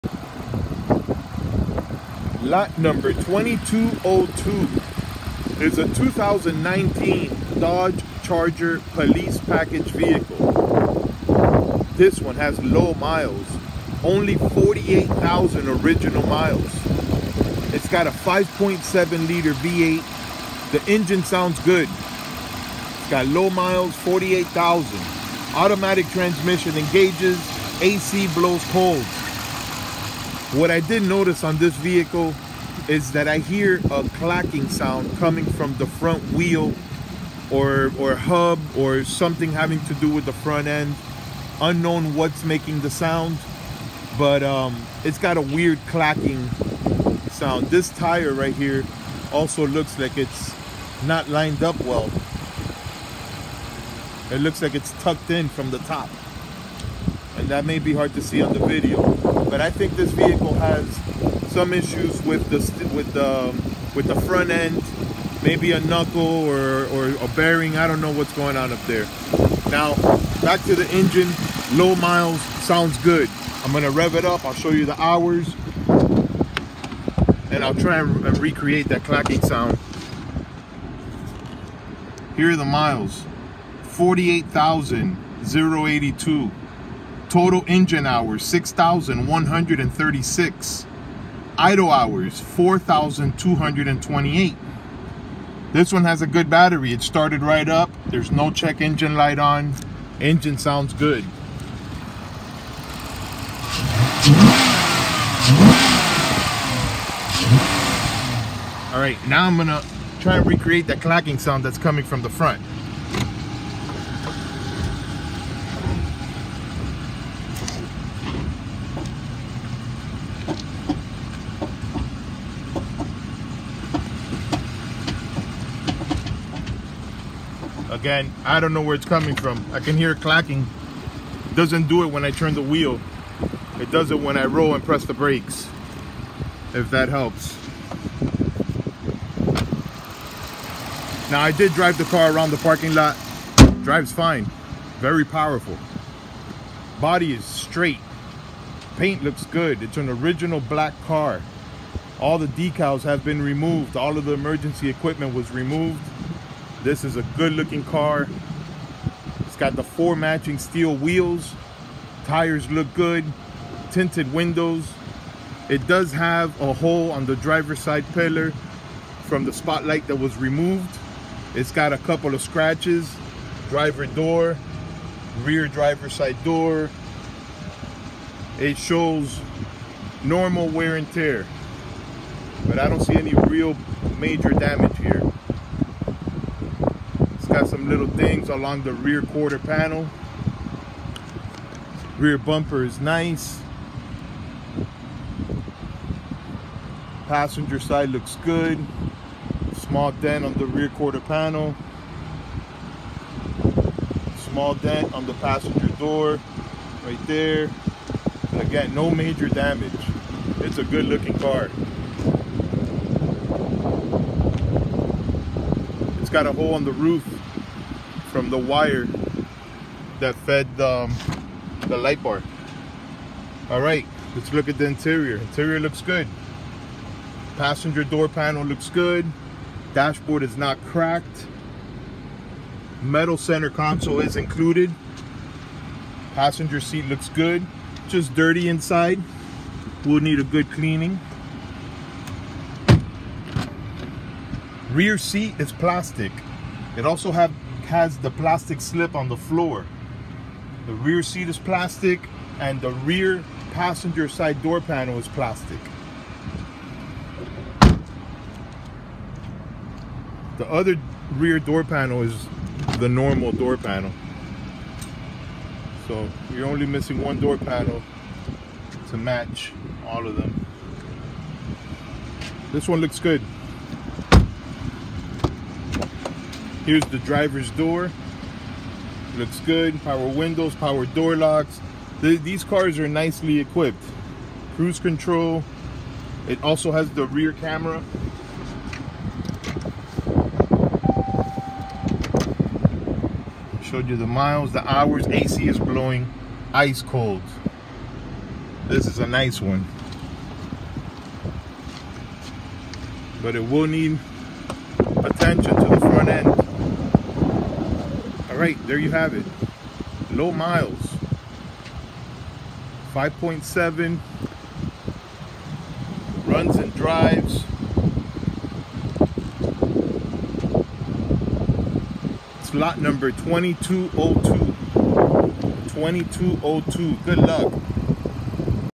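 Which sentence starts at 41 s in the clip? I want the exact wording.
Unknown what's making the sound, but um, it's got a weird clacking sound.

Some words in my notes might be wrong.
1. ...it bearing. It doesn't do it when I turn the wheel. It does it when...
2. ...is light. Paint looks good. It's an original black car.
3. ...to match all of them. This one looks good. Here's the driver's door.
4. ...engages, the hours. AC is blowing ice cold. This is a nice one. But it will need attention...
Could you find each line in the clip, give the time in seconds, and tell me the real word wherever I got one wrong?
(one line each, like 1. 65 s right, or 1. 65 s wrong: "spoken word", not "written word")
1. 130 s wrong: "clacking", not "bearing"
2. 147 s wrong: "straight", not "light"
3. 269 s right
4. 294 s wrong: "miles", not "engages".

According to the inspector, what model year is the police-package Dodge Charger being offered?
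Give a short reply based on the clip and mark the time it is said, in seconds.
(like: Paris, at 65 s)
2019, at 5 s.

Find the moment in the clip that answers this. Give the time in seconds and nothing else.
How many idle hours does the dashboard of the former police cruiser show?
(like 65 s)
92 s.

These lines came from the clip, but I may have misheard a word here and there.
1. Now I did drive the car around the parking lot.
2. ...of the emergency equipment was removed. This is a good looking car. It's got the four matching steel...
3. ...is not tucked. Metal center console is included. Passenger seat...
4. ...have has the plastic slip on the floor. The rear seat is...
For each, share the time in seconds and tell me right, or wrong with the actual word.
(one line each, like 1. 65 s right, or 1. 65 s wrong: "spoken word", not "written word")
1. 141 s right
2. 154 s right
3. 230 s wrong: "cracked", not "tucked"
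4. 247 s right.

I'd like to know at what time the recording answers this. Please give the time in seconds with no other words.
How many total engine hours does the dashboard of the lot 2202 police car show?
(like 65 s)
88 s.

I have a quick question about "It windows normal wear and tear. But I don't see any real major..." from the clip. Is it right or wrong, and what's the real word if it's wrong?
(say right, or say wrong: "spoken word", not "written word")
wrong: "shows", not "windows".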